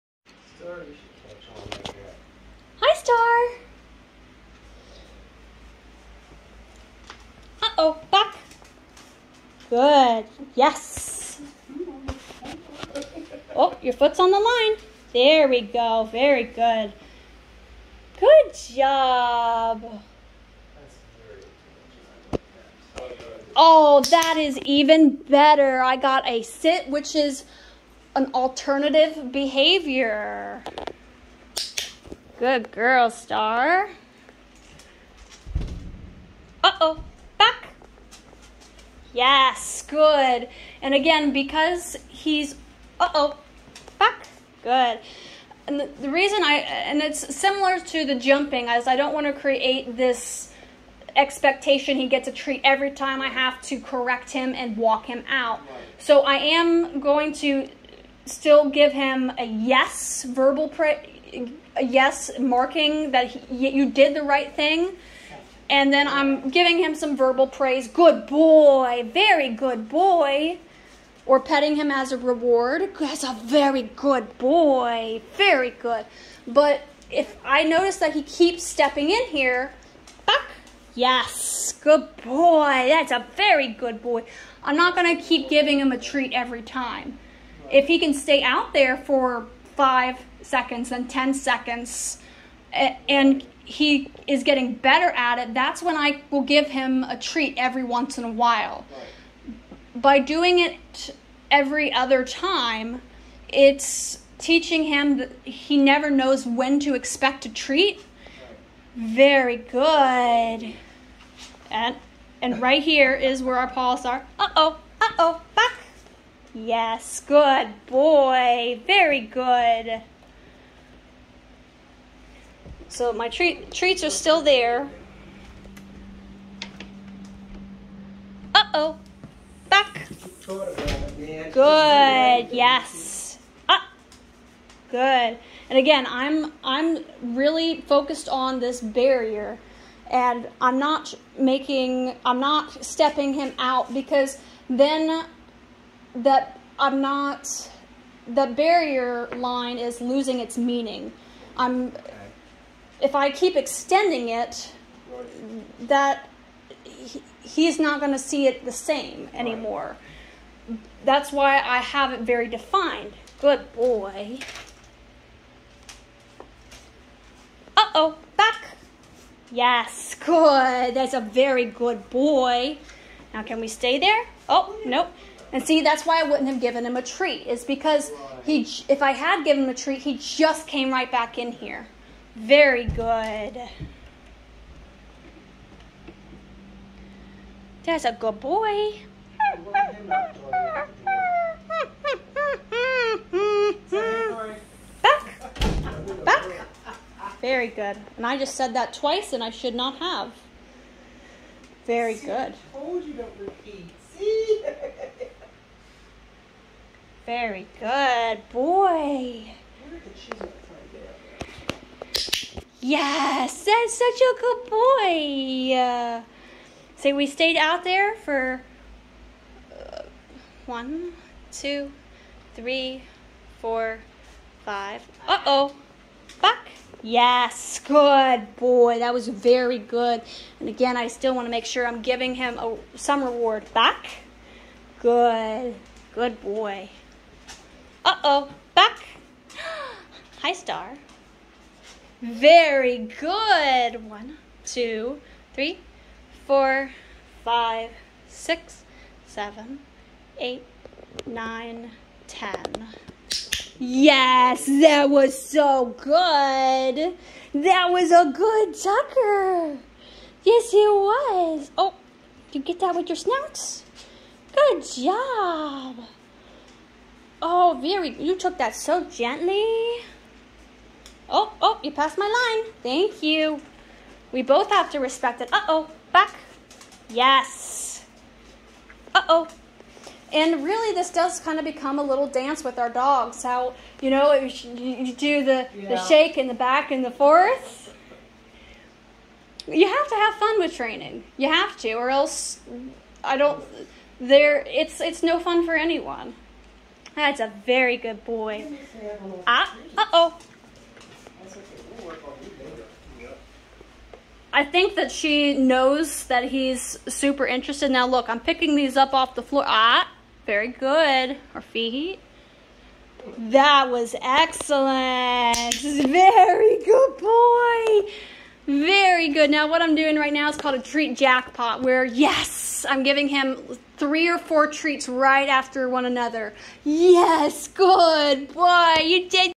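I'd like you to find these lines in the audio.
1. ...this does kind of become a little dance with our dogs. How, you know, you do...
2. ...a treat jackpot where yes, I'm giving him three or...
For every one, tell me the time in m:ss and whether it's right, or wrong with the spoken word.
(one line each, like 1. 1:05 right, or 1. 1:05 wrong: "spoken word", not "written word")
1. 4:40 right
2. 5:20 right.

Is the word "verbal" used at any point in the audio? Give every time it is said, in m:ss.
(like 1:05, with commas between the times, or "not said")
1:00, 1:07.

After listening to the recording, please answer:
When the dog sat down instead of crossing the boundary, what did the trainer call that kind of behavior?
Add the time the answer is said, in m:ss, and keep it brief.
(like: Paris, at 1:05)
alternative behavior, at 0:28.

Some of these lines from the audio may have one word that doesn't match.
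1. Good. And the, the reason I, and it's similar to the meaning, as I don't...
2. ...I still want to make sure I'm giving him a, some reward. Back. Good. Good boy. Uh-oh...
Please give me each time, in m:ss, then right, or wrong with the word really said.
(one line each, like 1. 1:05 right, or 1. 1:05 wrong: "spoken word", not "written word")
1. 0:44 wrong: "jumping", not "meaning"
2. 3:50 right.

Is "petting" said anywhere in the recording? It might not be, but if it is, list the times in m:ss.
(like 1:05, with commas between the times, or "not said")
1:11.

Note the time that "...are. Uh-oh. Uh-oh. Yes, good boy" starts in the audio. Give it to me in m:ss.
1:54.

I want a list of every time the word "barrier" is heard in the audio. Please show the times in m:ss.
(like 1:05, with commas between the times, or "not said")
2:18, 2:28.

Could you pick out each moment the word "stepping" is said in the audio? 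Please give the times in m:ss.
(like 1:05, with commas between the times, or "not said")
1:18, 2:22.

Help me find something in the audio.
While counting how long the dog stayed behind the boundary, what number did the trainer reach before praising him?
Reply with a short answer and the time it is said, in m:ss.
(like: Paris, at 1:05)
10, at 4:12.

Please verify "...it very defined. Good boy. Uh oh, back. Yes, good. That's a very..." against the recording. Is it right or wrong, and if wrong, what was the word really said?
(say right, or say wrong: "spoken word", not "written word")
right.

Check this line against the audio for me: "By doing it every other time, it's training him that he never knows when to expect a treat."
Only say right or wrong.
wrong.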